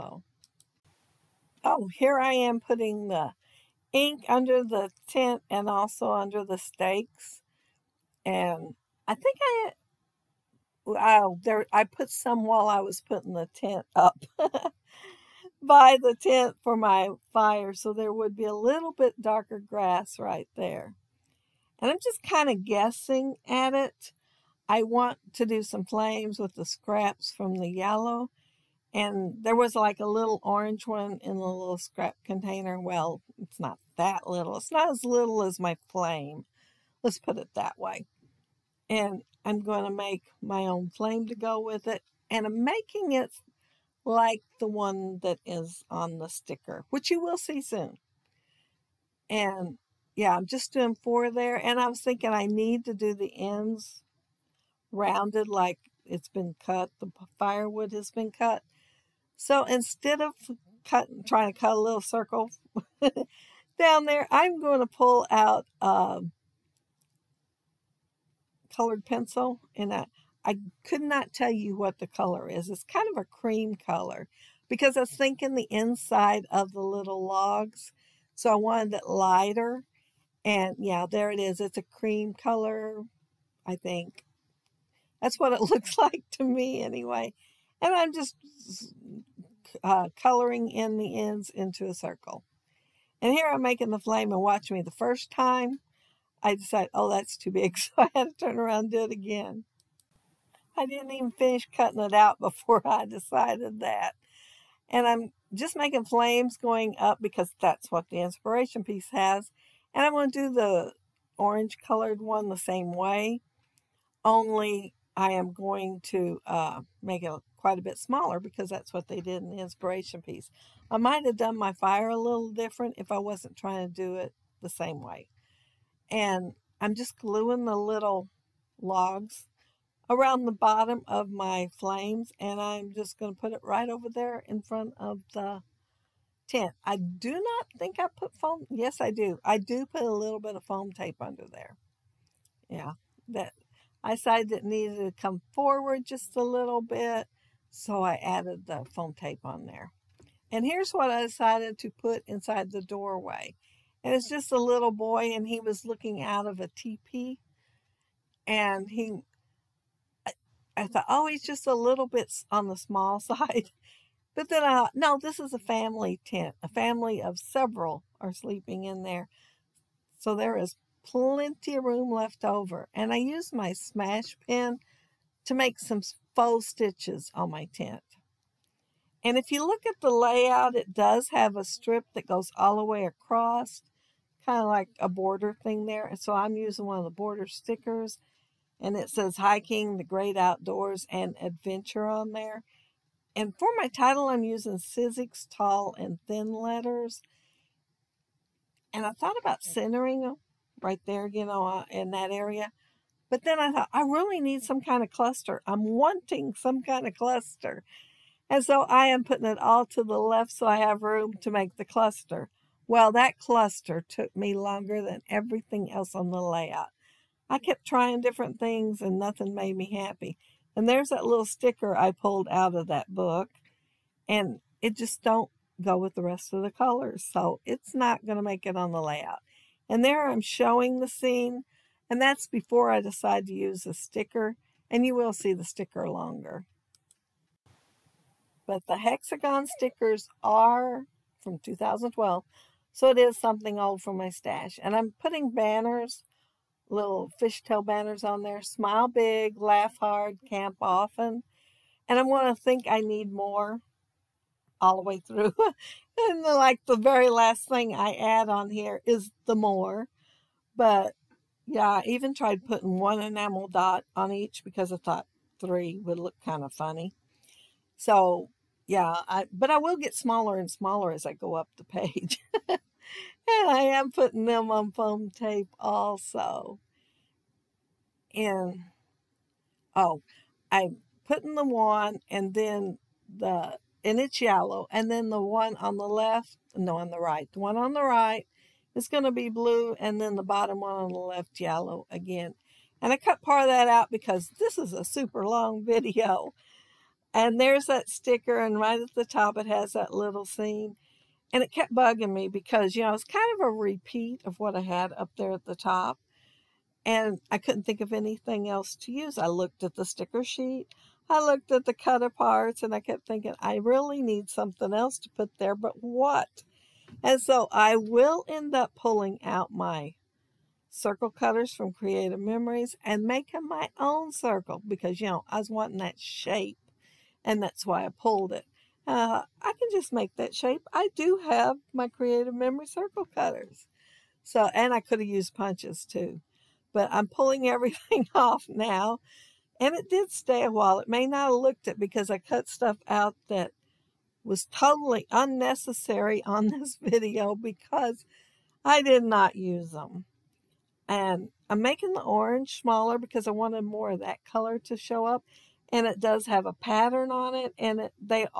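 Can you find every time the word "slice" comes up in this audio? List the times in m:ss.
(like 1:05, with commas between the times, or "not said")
not said.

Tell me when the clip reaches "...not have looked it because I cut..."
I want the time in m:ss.
5:41.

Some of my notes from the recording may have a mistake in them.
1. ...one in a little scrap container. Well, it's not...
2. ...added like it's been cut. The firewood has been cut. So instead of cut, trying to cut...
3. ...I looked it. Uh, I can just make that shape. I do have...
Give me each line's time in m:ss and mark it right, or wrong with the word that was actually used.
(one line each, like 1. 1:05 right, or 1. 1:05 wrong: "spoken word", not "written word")
1. 0:30 right
2. 0:54 wrong: "rounded", not "added"
3. 5:28 wrong: "pulled", not "looked".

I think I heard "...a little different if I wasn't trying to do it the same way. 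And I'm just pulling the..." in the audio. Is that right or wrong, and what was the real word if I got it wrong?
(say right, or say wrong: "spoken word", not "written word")
wrong: "gluing", not "pulling".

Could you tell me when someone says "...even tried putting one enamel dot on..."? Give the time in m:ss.
4:22.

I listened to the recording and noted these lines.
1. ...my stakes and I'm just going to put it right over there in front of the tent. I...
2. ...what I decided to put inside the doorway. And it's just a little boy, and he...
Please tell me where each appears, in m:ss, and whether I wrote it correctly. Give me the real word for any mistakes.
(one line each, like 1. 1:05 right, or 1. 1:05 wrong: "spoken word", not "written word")
1. 2:11 wrong: "flames", not "stakes"
2. 2:30 right.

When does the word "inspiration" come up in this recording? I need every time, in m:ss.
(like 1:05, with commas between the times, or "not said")
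1:48, 1:59.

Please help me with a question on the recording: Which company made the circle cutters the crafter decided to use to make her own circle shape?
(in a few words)
Creative Memories.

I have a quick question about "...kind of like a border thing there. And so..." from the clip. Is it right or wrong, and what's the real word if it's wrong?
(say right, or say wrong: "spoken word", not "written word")
right.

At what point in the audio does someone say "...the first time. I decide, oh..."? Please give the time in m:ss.
1:34.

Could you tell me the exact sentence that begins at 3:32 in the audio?
Well, that cluster took me longer than everything else on the layout.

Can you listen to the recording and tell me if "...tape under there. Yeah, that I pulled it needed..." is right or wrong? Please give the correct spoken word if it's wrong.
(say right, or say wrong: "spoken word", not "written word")
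wrong: "decided", not "pulled".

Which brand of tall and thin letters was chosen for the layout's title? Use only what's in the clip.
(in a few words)
Sizzix.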